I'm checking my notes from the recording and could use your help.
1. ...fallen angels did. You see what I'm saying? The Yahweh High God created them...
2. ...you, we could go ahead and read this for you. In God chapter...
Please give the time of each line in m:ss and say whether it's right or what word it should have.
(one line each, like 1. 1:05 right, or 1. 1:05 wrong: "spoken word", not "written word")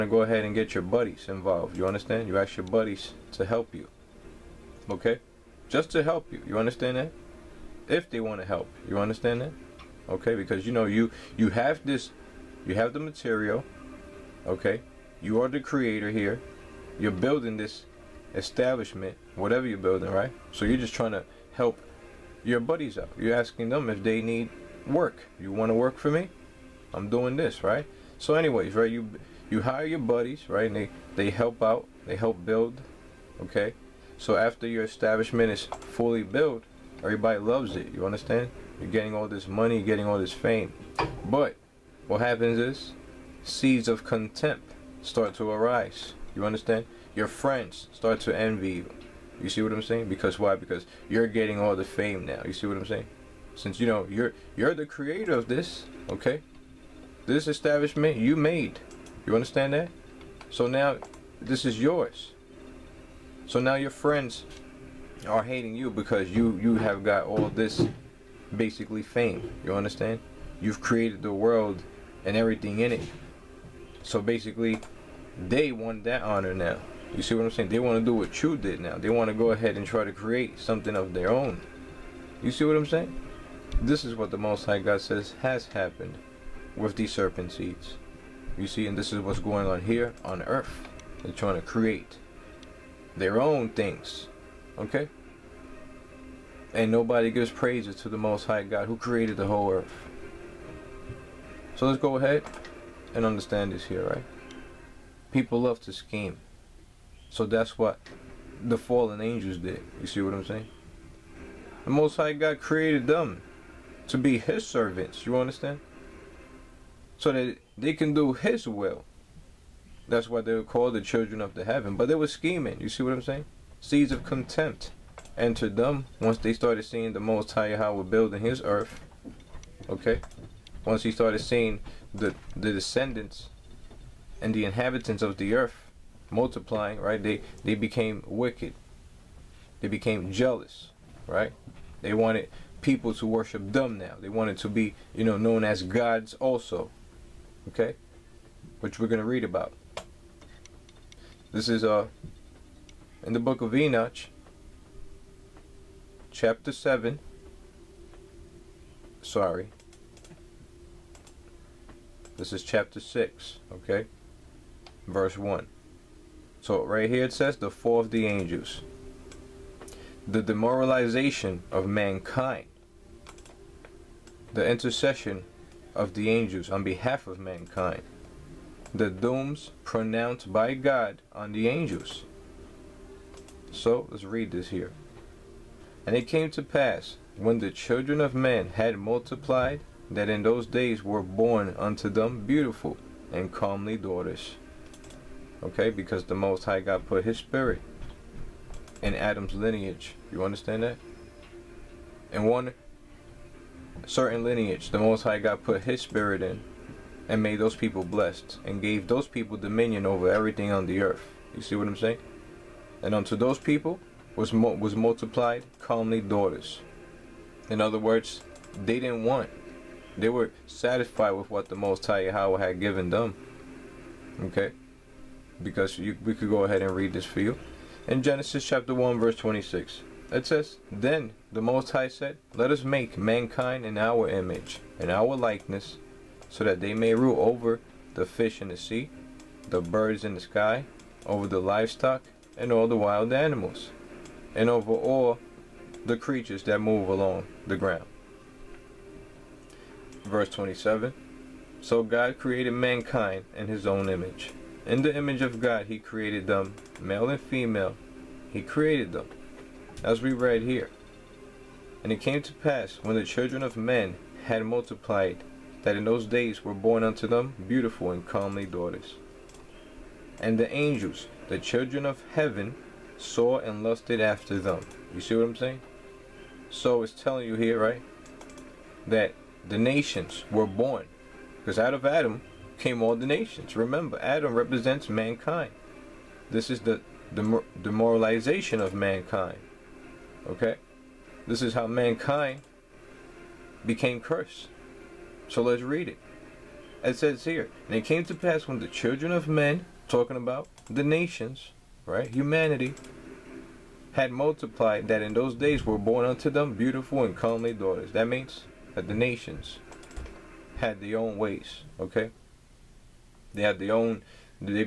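1. 1:48 wrong: "Most", not "Yahweh"
2. 3:45 wrong: "Genesis", not "God".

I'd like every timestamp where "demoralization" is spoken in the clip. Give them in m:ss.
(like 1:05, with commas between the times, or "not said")
2:50, 4:47.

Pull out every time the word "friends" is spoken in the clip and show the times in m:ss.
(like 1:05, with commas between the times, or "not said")
0:47, 1:03.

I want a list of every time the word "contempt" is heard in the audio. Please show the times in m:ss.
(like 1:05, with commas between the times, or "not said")
0:44, 2:04.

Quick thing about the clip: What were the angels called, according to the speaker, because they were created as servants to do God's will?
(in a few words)
Children of heaven.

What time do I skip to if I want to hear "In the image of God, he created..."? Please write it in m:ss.
4:14.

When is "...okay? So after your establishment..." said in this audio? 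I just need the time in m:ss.
0:33.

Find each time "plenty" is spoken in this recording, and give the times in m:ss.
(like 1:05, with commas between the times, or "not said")
not said.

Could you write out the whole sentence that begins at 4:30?
And the angels, the children of heaven, saw and lusted after them.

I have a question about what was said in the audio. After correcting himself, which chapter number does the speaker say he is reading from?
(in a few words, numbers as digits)
6.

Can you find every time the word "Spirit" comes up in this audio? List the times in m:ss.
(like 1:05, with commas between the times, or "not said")
3:17, 3:26.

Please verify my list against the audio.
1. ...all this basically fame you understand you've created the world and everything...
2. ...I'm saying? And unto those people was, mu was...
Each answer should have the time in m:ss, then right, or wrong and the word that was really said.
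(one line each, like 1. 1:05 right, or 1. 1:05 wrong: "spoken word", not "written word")
1. 1:07 right
2. 3:31 right.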